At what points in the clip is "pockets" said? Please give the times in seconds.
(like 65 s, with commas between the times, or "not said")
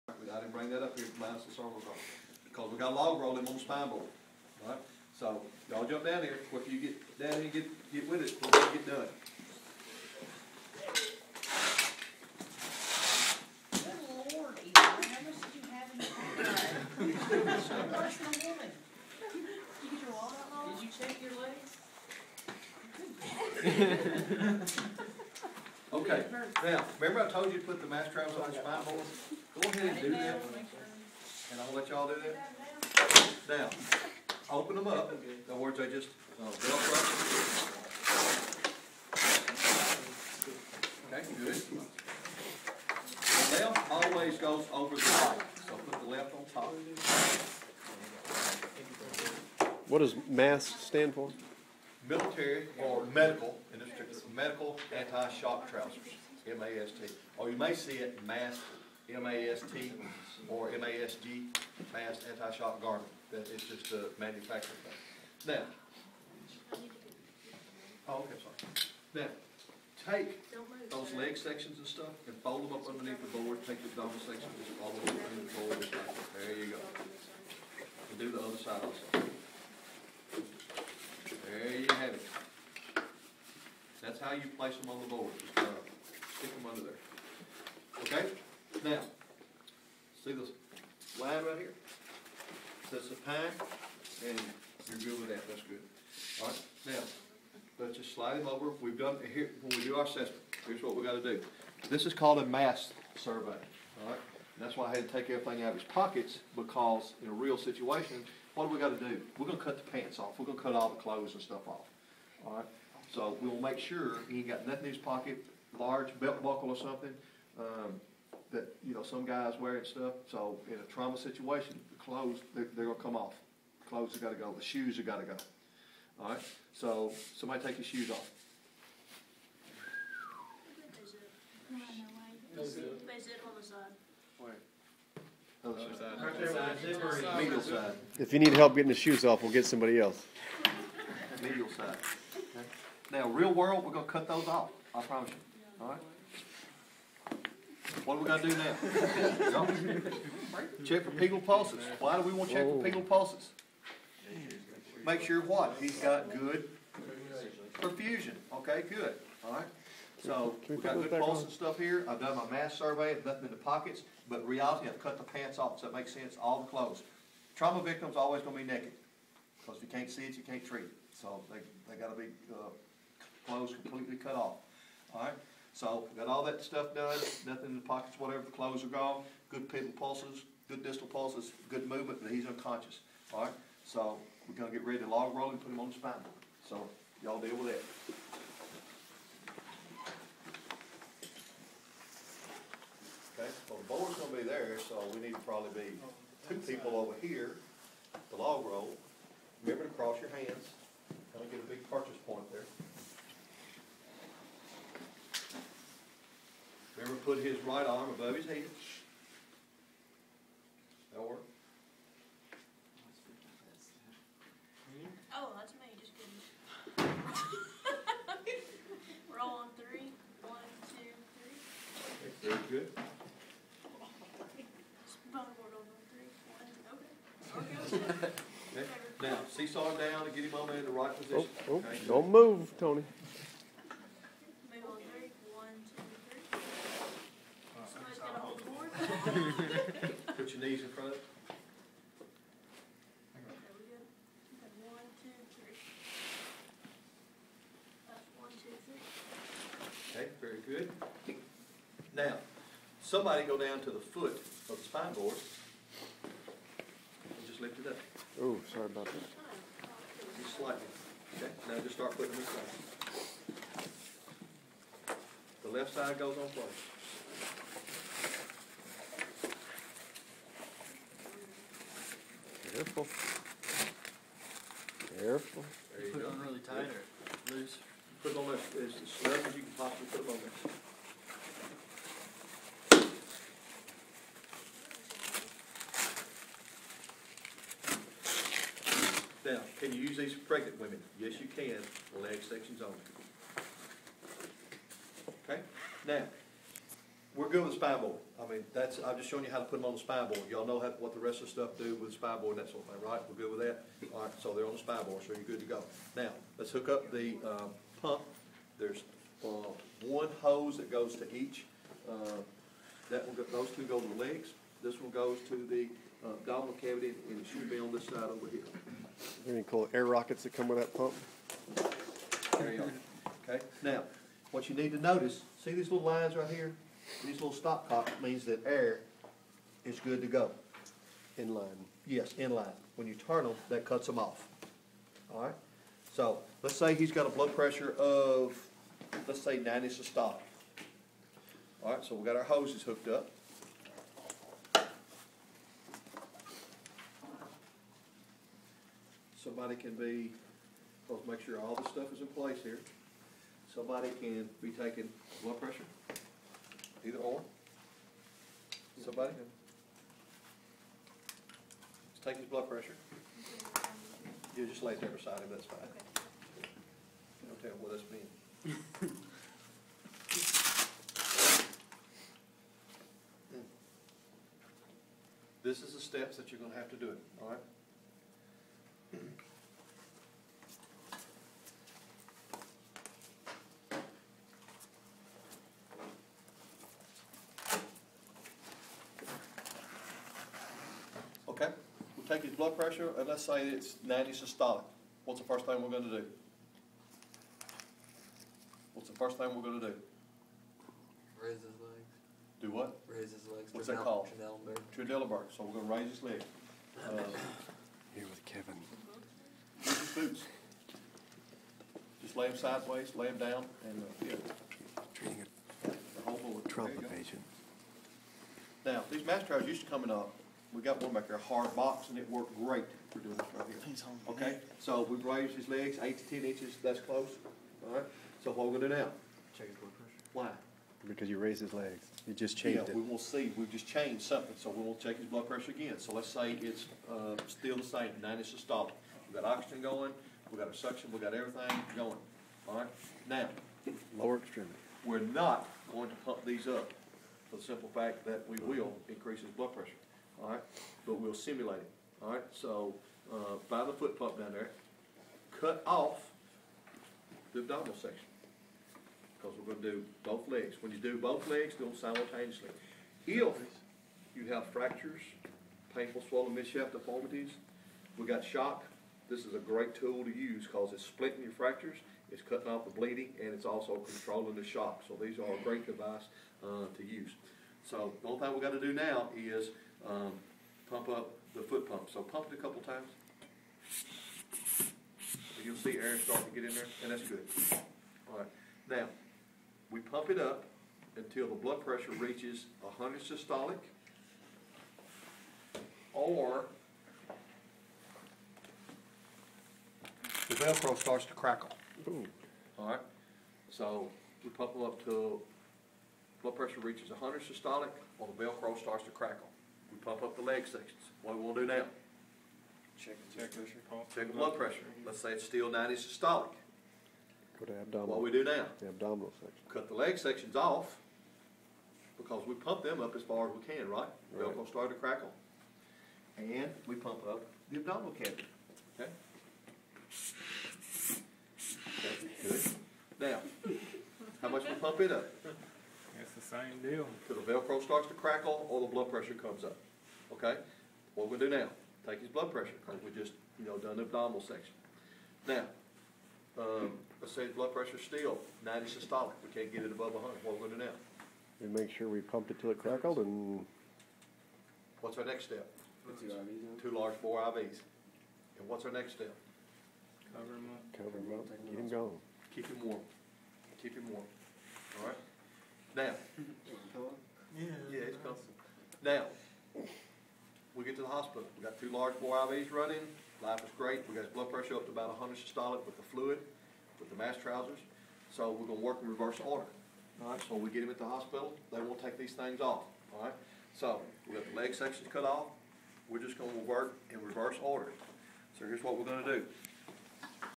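105 s, 114 s, 163 s, 177 s.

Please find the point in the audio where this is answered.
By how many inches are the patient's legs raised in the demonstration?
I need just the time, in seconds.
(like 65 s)
426 s.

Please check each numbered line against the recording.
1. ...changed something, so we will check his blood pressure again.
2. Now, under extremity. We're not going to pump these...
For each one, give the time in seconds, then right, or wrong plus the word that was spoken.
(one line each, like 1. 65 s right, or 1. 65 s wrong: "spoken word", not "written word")
1. 433 s right
2. 443 s wrong: "lower", not "under".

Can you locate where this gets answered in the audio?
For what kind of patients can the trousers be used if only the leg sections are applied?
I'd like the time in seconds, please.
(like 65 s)
290 s.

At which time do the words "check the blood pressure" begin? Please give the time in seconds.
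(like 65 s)
514 s.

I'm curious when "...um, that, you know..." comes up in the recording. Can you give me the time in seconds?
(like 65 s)
117 s.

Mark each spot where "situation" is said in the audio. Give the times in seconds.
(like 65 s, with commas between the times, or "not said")
107 s, 121 s.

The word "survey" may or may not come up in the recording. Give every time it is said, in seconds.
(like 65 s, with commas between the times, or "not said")
103 s, 162 s.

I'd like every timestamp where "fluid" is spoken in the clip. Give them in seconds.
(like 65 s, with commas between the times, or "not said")
576 s.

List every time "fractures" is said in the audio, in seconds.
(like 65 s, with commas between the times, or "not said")
464 s, 471 s.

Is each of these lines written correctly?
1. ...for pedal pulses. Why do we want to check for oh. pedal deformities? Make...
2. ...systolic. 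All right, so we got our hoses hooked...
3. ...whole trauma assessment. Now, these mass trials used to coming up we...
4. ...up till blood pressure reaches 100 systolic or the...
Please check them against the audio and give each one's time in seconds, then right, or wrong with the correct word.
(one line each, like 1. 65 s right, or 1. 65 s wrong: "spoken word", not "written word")
1. 151 s wrong: "pulses", not "deformities"
2. 339 s right
3. 416 s wrong: "patient", not "assessment"
4. 504 s right.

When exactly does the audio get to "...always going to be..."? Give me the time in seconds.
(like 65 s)
168 s.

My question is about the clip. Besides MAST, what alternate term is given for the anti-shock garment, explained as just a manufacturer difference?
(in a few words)
MASG.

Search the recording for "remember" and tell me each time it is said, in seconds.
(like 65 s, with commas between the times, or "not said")
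26 s, 199 s.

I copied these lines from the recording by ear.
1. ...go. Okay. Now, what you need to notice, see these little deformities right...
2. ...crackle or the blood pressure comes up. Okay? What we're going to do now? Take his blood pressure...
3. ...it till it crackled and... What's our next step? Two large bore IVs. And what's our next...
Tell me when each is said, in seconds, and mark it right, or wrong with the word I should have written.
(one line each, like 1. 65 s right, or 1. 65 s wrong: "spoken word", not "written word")
1. 322 s wrong: "lines", not "deformities"
2. 538 s right
3. 552 s right.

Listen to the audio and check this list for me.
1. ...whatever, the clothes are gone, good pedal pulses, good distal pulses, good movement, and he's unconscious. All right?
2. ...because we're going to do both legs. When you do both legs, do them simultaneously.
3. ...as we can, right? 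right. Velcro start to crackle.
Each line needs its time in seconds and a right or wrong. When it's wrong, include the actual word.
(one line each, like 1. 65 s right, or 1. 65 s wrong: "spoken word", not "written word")
1. 178 s right
2. 459 s right
3. 523 s right.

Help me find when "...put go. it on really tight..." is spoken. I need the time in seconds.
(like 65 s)
276 s.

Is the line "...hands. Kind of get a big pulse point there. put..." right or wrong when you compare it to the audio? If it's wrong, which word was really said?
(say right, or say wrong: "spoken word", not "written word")
wrong: "purchase", not "pulse".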